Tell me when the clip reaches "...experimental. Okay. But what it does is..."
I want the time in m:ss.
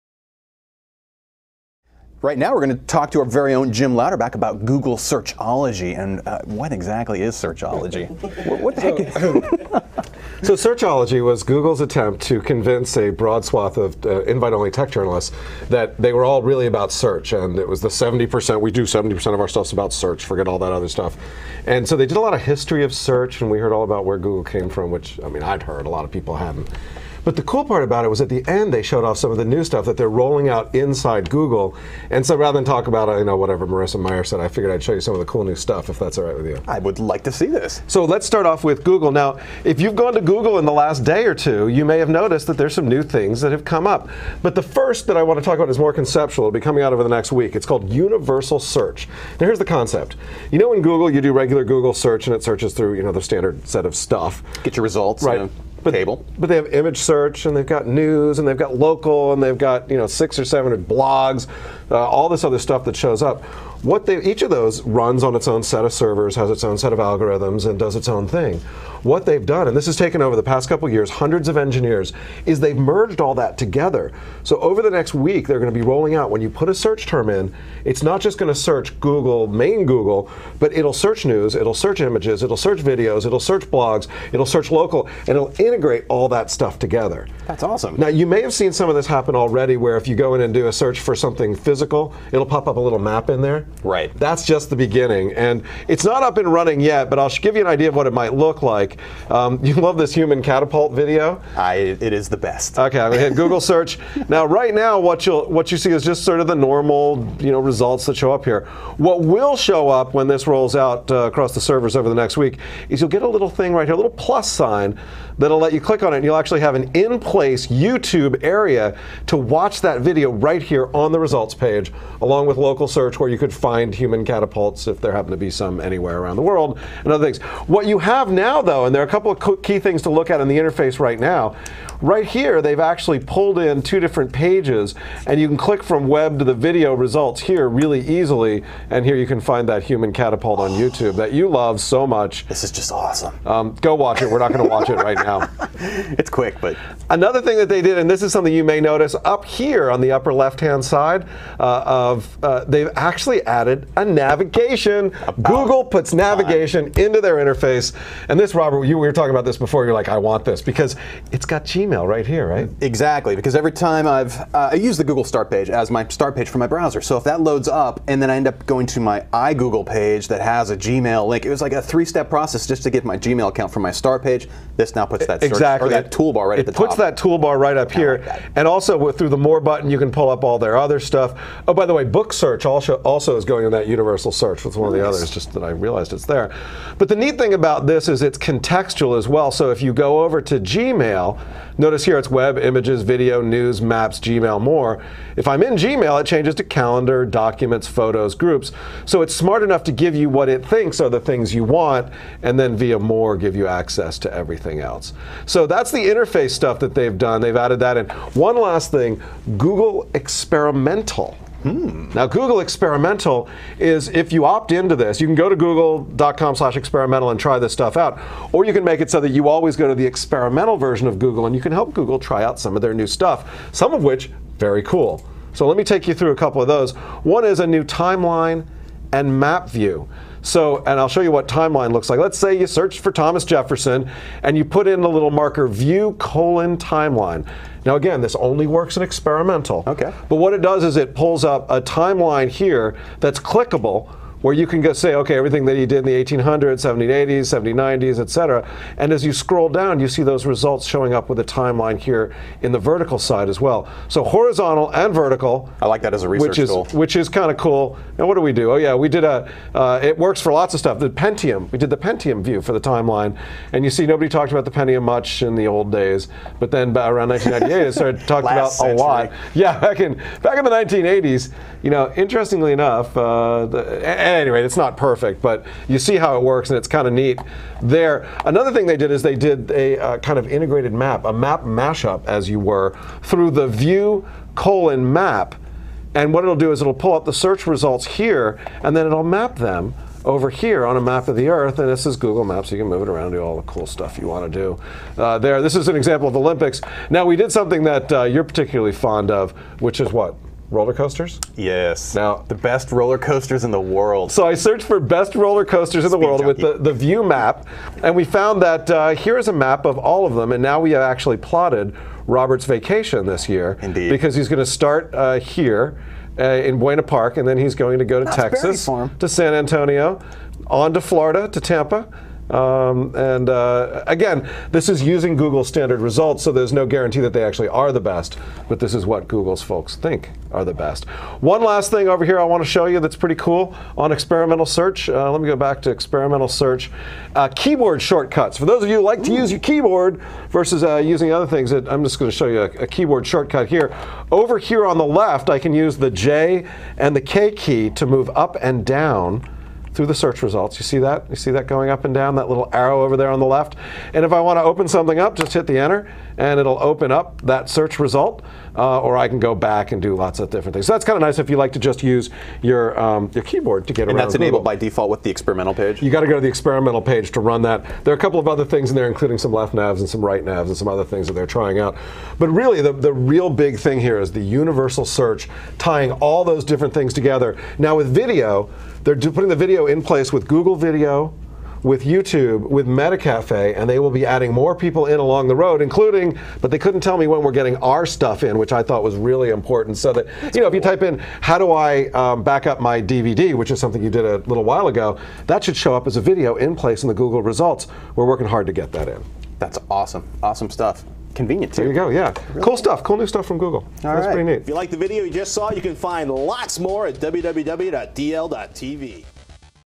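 3:59.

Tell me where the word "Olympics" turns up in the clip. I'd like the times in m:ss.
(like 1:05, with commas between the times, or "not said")
4:56.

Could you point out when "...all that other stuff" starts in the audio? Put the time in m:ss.
0:20.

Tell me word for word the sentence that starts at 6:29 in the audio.
So that, That's you know, cool.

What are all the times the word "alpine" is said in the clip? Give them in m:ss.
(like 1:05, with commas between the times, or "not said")
not said.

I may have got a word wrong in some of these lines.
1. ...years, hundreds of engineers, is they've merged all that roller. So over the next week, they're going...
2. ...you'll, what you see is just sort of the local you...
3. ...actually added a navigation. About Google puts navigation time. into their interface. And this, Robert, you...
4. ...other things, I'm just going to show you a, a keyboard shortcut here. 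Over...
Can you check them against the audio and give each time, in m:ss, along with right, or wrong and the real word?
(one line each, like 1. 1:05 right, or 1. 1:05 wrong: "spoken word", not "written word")
1. 1:10 wrong: "together", not "roller"
2. 1:45 wrong: "normal", not "local"
3. 2:32 right
4. 5:41 right.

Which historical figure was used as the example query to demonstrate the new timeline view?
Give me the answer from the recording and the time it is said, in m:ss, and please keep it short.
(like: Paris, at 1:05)
Thomas Jefferson, at 3:53.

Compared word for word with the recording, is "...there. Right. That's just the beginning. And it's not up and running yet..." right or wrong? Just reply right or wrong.
right.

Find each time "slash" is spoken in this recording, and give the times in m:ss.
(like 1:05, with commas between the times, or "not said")
3:36.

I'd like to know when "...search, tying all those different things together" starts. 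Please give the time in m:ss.
6:15.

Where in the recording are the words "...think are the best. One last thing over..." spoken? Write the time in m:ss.
5:29.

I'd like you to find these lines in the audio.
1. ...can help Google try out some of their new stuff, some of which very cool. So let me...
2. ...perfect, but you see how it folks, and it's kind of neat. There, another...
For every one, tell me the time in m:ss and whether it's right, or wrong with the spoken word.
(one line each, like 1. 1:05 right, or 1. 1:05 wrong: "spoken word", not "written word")
1. 3:41 right
2. 4:34 wrong: "works", not "folks".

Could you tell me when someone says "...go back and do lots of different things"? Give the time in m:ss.
5:59.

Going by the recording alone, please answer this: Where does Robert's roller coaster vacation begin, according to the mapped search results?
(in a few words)
Buena Park.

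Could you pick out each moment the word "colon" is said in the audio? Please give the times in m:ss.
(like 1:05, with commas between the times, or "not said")
3:56, 4:44.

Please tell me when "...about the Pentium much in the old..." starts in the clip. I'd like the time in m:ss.
4:24.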